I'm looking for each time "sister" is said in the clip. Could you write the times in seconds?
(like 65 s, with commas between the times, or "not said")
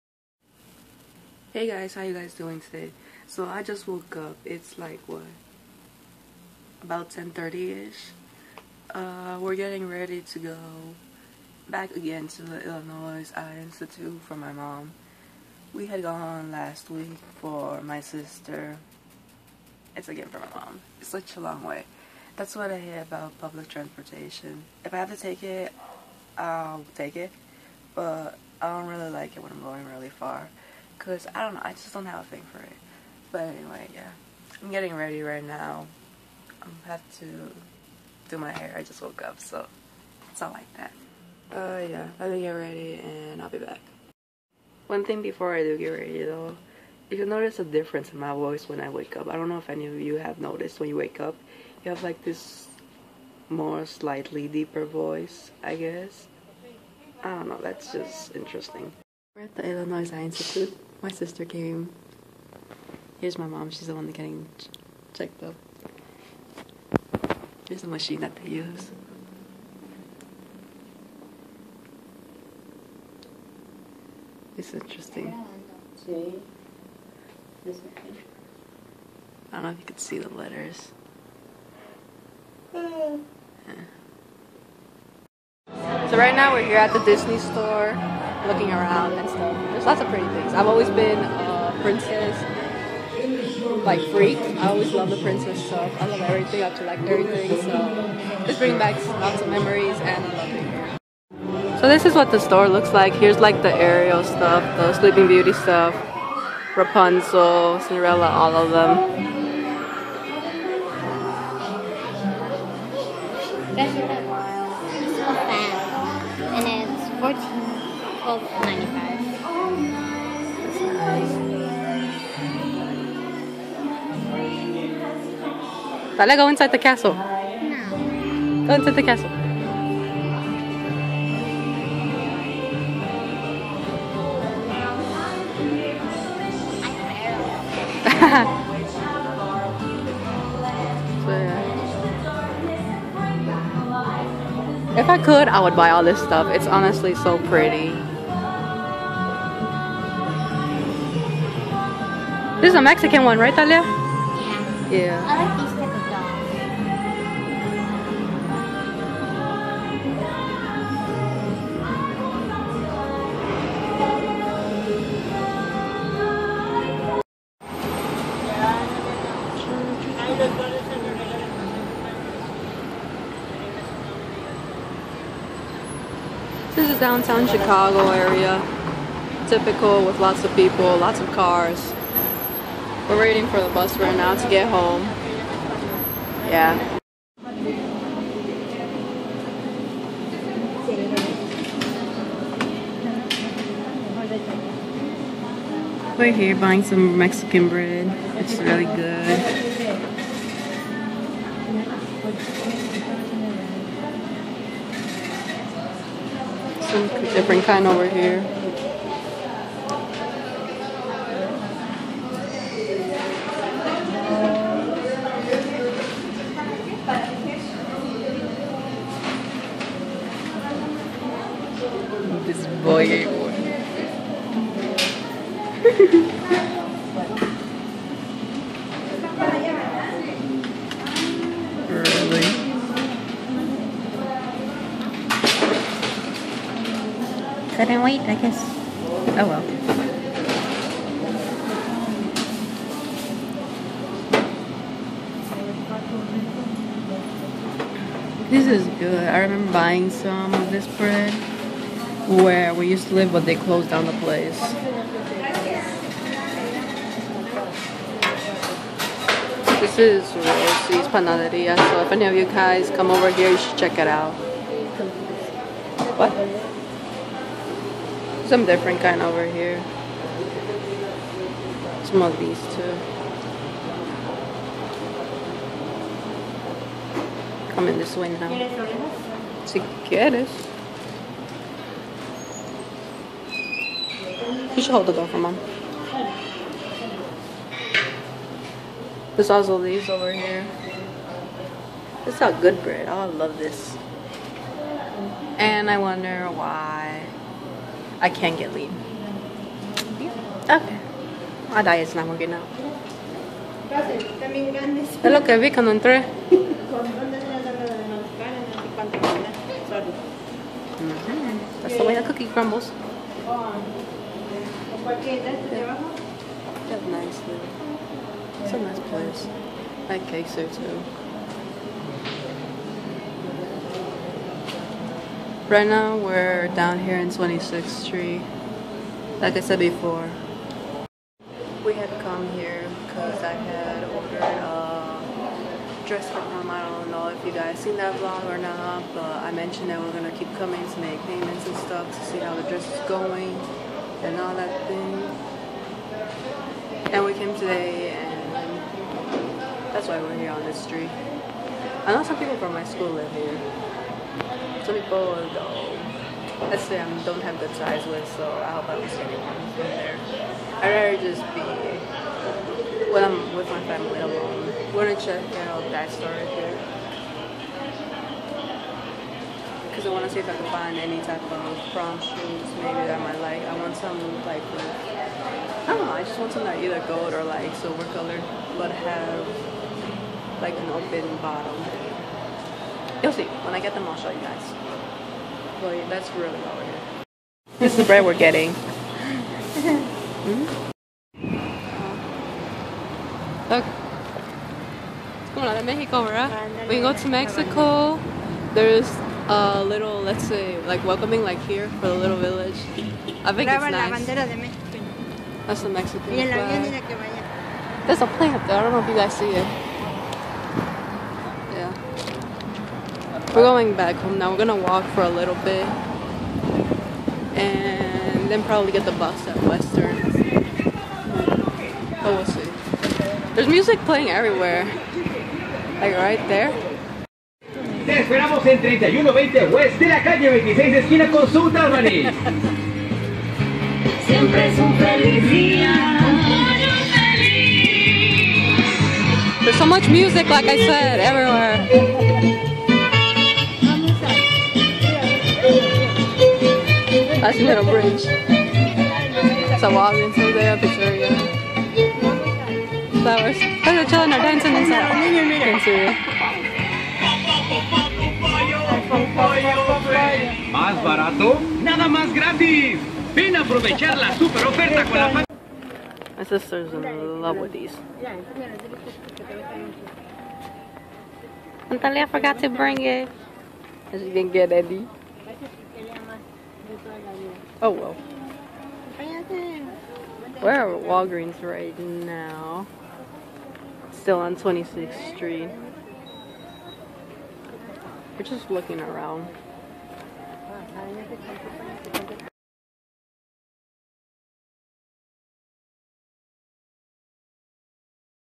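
17 s, 61 s, 466 s.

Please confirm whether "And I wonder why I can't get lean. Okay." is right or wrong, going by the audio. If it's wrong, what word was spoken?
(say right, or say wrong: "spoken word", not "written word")
right.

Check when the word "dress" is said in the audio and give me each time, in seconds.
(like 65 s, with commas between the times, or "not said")
336 s, 342 s.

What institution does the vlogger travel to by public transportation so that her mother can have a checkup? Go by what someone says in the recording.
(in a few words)
Illinois Eye Institute.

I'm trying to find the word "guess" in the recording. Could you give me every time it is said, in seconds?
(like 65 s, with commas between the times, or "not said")
55 s, 238 s.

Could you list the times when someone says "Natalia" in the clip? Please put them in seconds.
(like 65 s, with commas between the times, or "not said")
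471 s.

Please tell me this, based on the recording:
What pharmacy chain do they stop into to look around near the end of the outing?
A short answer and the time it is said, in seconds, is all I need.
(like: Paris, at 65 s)
Walgreens, at 481 s.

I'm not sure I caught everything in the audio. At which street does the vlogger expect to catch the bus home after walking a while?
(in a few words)
Western.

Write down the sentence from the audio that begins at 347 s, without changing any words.
And we came today and that's why we're here on this street.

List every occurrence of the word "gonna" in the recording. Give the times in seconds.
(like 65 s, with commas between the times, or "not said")
340 s, 365 s, 414 s.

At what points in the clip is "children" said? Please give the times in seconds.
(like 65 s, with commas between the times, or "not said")
454 s.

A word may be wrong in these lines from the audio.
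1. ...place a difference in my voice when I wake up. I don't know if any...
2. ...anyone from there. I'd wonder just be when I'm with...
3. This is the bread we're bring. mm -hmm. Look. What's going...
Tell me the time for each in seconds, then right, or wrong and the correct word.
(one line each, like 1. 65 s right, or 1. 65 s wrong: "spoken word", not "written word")
1. 47 s wrong: "notice", not "place"
2. 359 s wrong: "rather", not "wonder"
3. 387 s wrong: "getting", not "bring".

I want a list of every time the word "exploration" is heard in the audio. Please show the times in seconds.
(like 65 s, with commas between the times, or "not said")
not said.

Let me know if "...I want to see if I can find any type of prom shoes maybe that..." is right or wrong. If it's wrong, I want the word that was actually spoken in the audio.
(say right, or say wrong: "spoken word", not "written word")
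right.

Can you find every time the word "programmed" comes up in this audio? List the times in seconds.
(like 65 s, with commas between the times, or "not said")
not said.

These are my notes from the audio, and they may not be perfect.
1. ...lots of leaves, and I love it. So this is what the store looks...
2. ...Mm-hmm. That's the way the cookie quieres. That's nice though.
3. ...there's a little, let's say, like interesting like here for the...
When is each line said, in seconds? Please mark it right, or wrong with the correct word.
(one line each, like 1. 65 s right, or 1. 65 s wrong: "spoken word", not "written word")
1. 99 s wrong: "memories", not "leaves"
2. 311 s wrong: "crumbles", not "quieres"
3. 398 s wrong: "welcoming", not "interesting".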